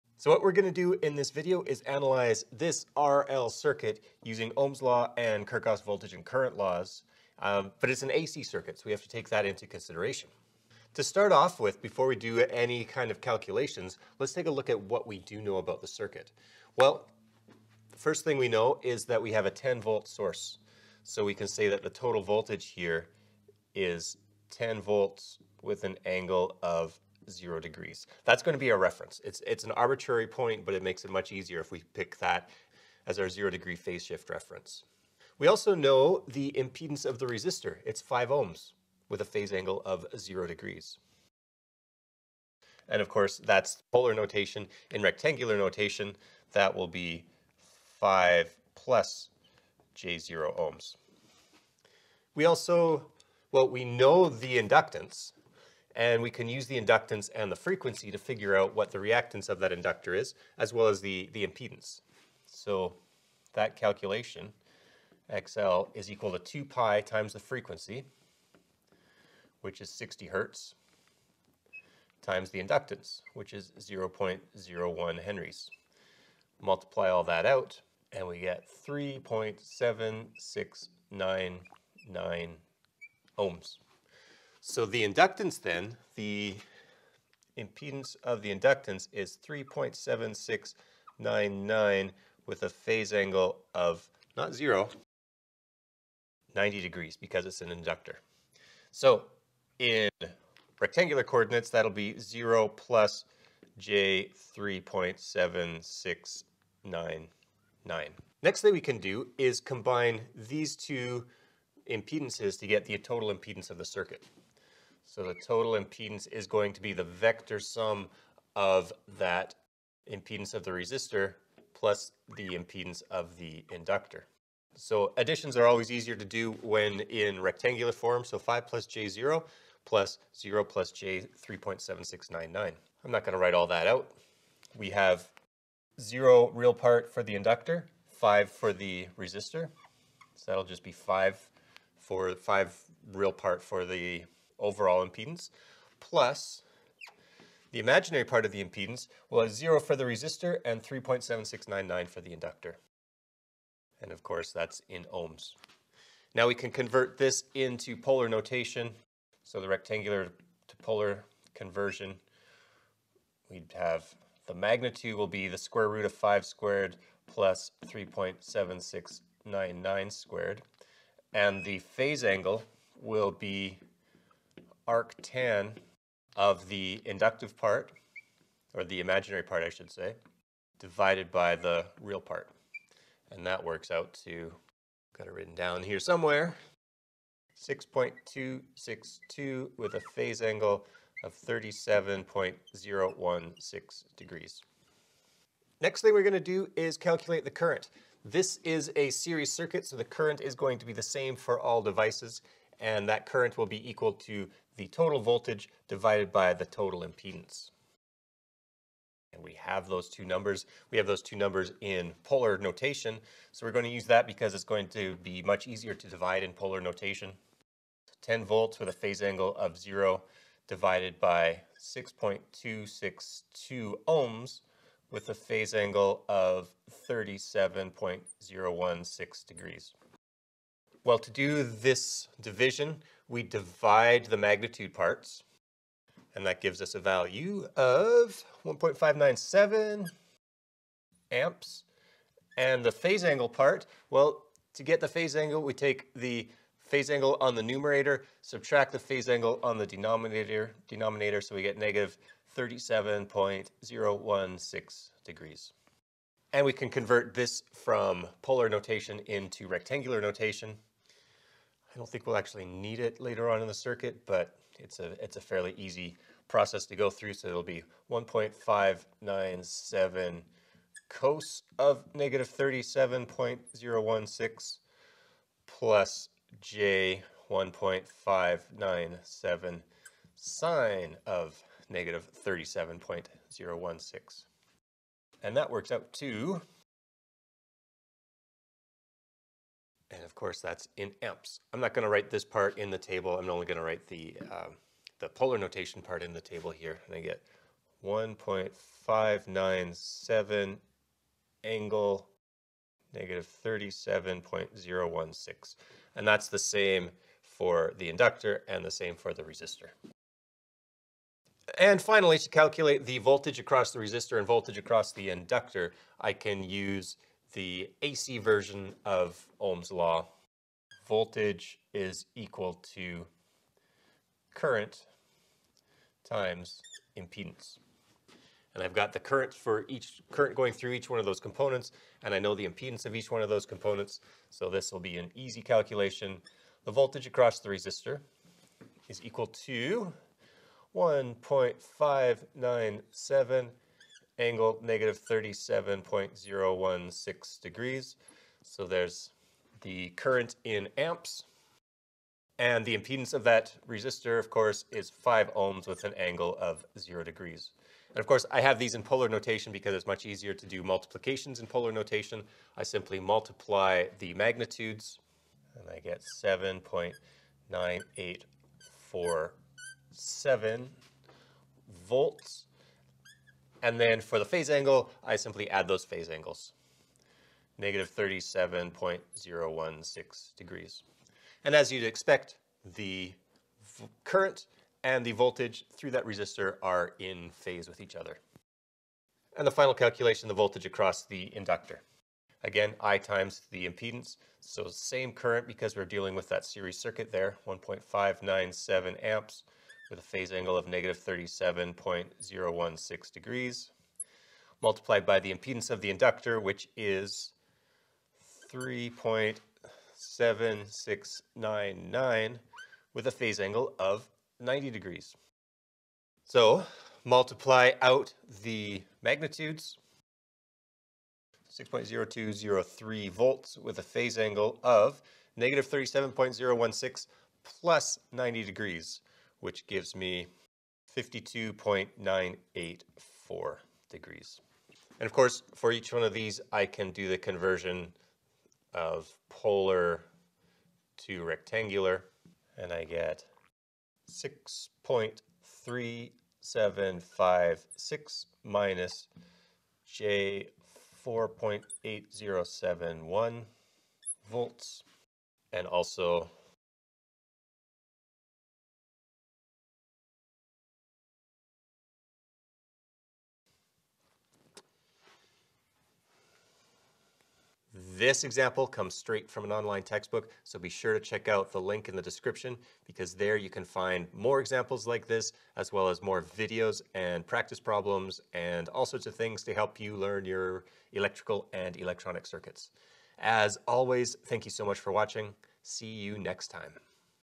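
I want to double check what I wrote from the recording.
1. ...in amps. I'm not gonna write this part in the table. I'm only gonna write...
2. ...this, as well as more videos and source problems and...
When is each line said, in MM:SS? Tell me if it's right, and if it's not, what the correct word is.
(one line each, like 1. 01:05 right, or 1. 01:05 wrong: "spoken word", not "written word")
1. 04:50 right
2. 07:55 wrong: "practice", not "source".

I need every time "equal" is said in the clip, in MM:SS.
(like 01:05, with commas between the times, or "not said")
01:06, 03:23, 05:22, 05:39.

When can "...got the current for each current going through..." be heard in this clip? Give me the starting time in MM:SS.
05:28.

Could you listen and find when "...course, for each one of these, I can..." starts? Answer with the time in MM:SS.
07:15.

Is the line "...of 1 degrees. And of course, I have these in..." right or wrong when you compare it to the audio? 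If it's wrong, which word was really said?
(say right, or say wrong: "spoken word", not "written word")
wrong: "0", not "1".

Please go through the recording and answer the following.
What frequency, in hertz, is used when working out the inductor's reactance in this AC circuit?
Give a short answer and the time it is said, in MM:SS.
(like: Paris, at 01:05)
60 hertz, at 01:09.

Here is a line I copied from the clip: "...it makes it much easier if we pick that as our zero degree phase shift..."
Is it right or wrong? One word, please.
right.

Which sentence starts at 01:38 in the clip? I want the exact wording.
So in rectangular coordinates, that'll be 0 plus j 3.7699.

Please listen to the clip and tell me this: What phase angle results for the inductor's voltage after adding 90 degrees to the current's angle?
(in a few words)
52.984 degrees.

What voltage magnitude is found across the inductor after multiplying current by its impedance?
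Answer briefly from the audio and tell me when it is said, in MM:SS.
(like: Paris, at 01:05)
6.0203 volts, at 07:01.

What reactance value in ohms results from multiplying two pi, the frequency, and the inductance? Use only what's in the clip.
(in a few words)
3.7699 ohms.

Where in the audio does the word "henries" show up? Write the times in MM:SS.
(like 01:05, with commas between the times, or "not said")
01:15.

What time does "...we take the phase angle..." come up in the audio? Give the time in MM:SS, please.
04:05.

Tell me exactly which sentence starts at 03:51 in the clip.
Well, to do this division, we divide the magnitude parts, and that gives us a value of 1.597 amps.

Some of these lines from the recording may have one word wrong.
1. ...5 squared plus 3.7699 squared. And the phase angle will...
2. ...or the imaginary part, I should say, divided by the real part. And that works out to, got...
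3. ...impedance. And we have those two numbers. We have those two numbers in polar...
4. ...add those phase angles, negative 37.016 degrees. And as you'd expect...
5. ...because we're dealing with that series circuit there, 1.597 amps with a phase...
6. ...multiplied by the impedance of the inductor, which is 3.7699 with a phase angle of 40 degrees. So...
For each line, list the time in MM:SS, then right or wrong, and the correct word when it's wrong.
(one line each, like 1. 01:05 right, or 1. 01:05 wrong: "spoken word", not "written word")
1. 02:46 right
2. 02:58 right
3. 03:27 right
4. 06:15 right
5. 06:35 right
6. 06:44 wrong: "90", not "40".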